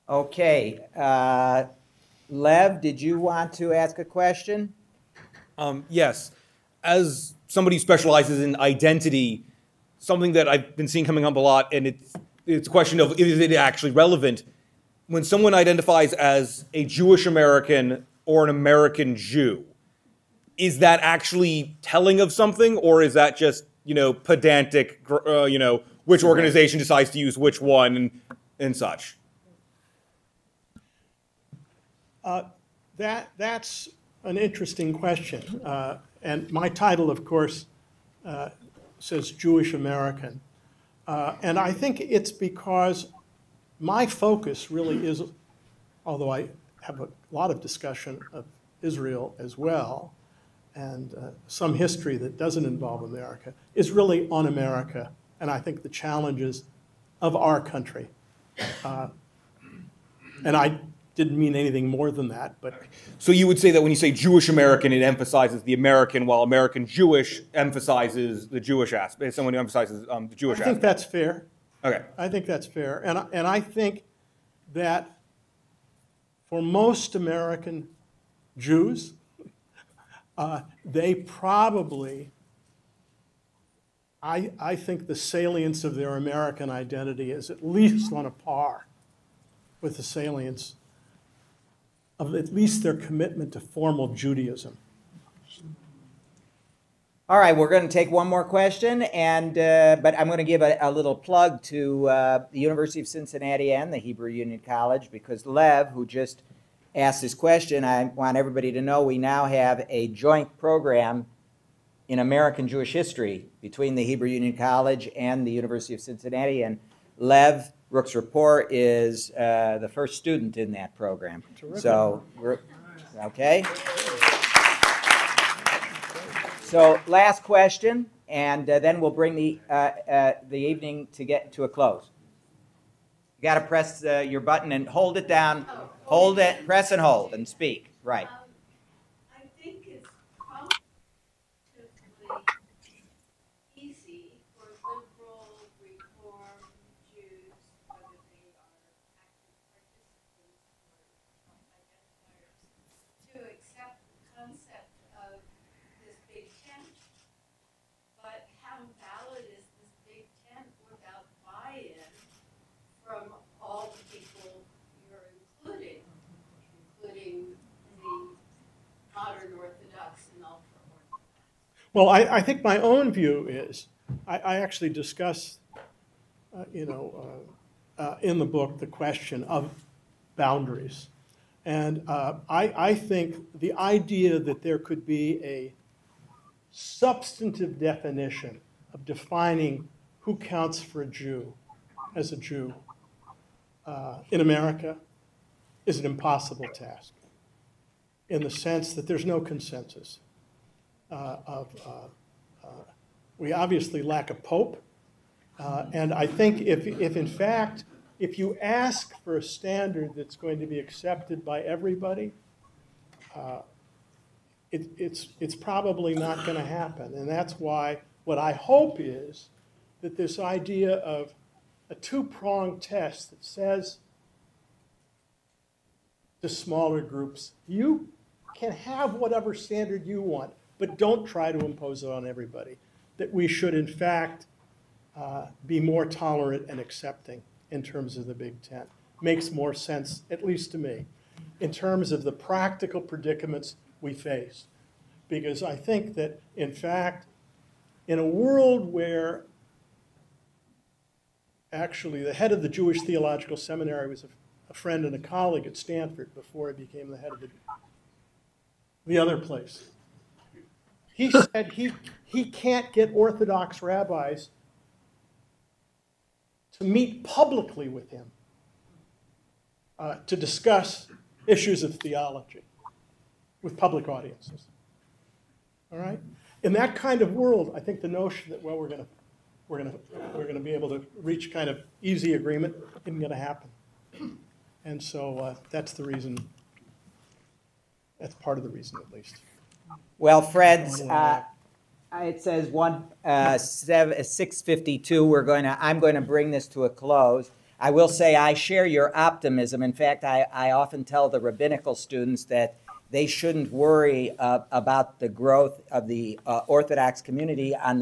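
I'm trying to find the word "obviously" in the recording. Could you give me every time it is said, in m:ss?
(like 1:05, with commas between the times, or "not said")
3:23.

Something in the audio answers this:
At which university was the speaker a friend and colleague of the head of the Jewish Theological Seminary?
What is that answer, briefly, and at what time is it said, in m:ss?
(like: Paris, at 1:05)
Stanford, at 4:15.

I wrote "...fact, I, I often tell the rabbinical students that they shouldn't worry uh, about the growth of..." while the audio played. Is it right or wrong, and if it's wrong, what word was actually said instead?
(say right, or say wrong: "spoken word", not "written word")
right.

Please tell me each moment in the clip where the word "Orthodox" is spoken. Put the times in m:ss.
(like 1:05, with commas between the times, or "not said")
4:23, 5:06.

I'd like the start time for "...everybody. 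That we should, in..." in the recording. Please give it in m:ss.
3:52.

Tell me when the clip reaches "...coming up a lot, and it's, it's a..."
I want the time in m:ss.
0:11.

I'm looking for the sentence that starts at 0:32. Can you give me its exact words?
Uh, that that's an interesting question.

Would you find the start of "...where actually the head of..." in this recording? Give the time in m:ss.
4:08.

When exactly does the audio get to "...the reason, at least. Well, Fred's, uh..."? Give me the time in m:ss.
4:48.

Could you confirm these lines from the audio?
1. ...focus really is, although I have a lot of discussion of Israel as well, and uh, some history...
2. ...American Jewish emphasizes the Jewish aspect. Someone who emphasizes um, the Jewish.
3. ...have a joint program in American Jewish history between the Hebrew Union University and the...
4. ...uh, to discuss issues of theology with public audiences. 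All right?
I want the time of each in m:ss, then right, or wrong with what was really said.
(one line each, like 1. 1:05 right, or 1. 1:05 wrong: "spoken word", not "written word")
1. 0:44 right
2. 1:06 right
3. 1:49 wrong: "College", not "University"
4. 4:29 right.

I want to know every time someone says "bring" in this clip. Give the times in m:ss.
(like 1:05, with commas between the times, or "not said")
2:09, 4:56.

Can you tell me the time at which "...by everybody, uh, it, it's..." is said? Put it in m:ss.
3:31.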